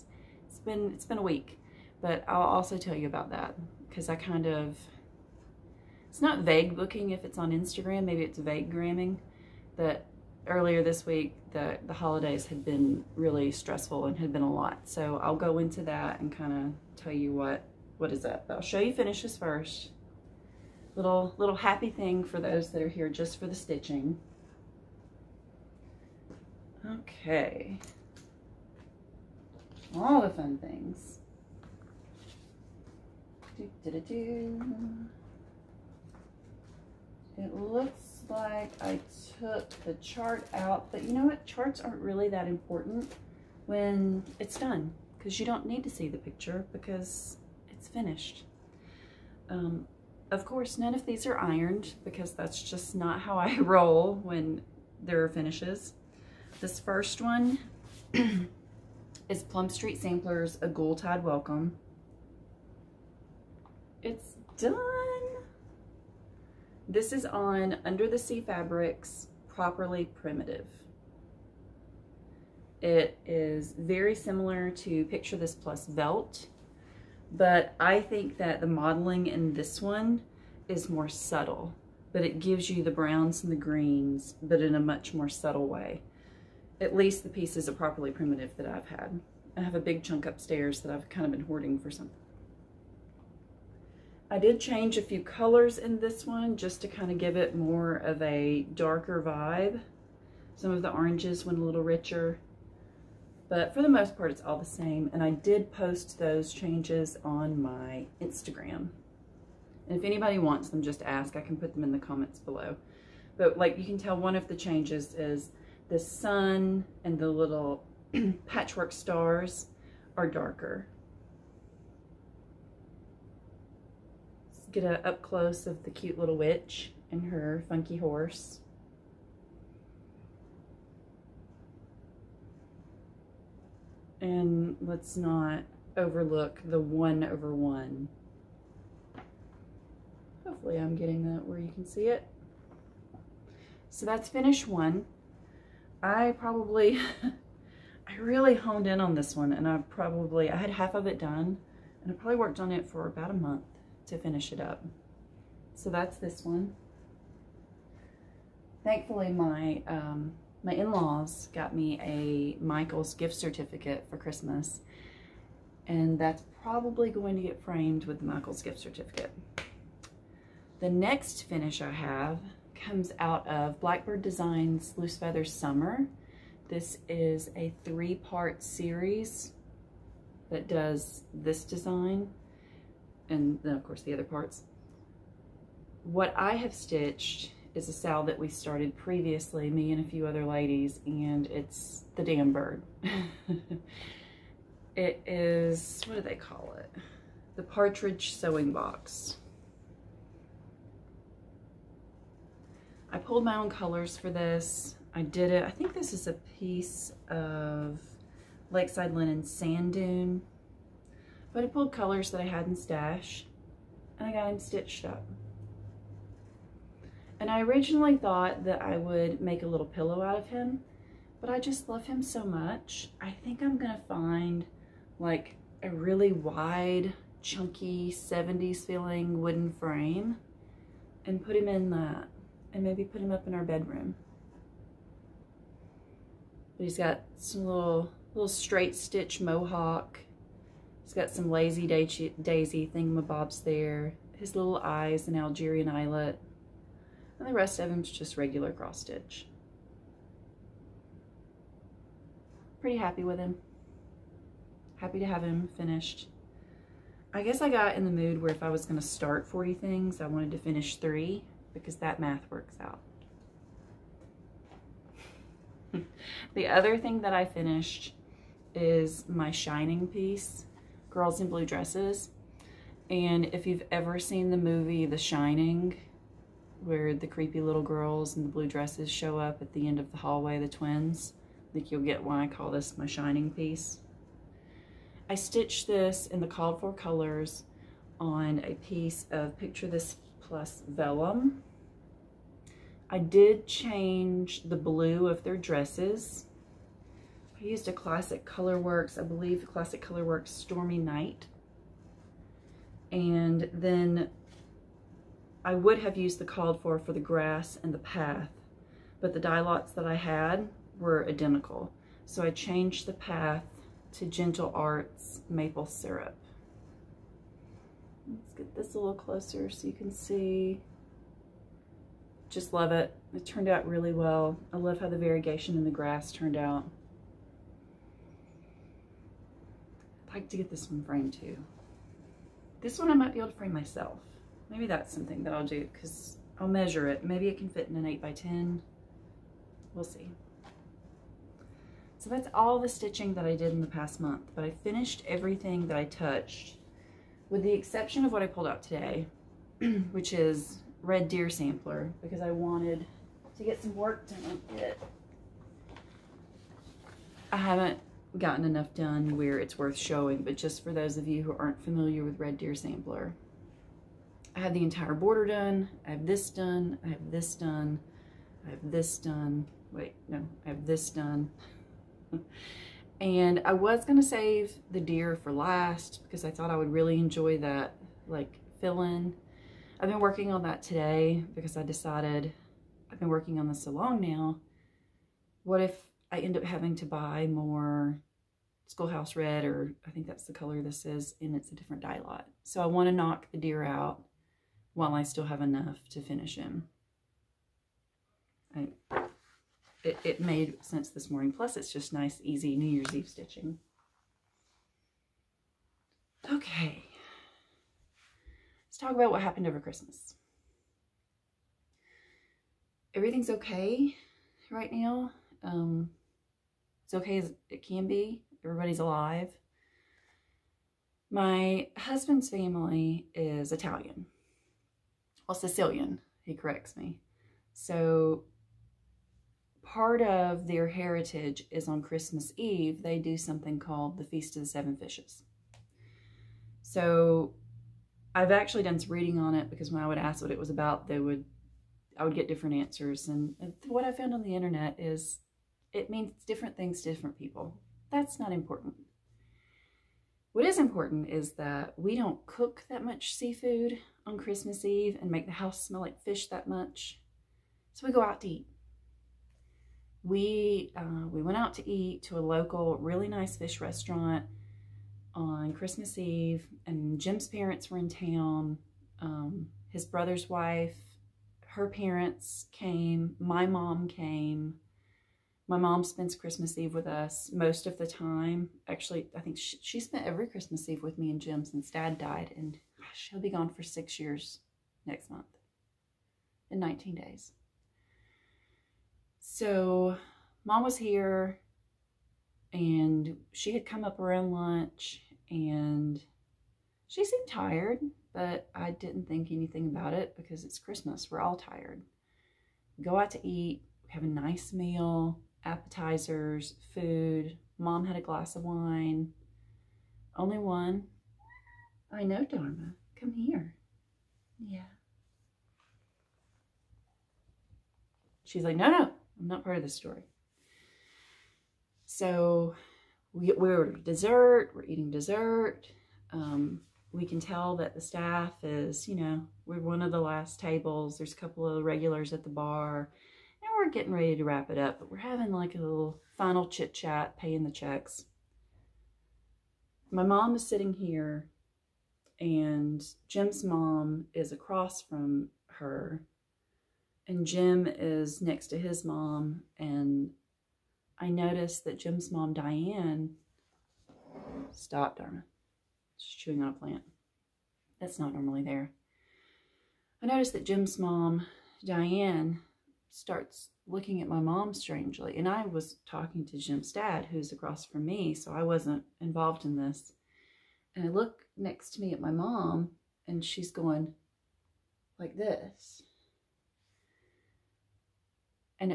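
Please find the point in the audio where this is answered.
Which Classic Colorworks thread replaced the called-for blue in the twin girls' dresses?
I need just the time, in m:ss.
5:00.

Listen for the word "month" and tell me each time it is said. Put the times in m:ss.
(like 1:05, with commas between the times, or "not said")
2:33, 5:44, 8:05.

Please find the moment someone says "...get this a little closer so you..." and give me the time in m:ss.
5:18.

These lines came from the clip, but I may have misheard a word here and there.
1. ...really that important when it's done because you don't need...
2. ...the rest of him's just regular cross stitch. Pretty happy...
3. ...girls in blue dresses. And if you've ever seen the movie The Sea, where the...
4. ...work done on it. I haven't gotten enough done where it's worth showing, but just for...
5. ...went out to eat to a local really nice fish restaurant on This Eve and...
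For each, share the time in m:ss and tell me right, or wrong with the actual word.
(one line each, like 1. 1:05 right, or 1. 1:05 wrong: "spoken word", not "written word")
1. 0:42 right
2. 4:07 right
3. 4:31 wrong: "Shining", not "Sea"
4. 5:53 right
5. 7:41 wrong: "Christmas", not "This".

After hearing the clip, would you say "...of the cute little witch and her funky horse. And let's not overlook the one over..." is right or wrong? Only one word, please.
right.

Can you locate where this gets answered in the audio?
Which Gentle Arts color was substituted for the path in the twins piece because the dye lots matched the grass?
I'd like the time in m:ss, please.
5:15.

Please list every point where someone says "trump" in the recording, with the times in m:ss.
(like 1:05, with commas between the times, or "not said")
not said.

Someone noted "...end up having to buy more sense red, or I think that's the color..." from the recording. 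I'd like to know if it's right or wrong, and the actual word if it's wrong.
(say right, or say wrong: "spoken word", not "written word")
wrong: "schoolhouse", not "sense".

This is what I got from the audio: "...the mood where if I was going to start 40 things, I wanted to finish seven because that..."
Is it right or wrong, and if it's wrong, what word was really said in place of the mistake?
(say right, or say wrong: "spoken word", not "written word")
wrong: "three", not "seven".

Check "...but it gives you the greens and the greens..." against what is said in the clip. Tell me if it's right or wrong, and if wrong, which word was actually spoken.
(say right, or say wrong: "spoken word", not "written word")
wrong: "browns", not "greens".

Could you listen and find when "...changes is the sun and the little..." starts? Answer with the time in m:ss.
1:54.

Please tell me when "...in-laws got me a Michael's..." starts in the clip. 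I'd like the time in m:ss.
2:40.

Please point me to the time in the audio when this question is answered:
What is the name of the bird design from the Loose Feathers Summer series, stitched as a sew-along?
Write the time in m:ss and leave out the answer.
3:17.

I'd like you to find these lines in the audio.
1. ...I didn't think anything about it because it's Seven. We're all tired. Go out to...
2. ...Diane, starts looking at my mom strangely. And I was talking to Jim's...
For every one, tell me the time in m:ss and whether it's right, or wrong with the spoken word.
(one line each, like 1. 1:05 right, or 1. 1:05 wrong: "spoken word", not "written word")
1. 8:18 wrong: "Christmas", not "Seven"
2. 9:21 right.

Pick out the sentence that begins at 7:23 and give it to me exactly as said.
And what I found on the internet is it means different things to different people.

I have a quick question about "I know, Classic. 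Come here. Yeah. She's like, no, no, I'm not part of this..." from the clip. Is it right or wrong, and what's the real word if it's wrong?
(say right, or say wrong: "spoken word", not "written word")
wrong: "Dharma", not "Classic".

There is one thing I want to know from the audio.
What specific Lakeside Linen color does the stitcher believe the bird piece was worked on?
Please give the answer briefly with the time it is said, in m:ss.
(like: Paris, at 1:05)
Sand Dune, at 3:29.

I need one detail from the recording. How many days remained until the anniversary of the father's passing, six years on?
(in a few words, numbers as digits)
19.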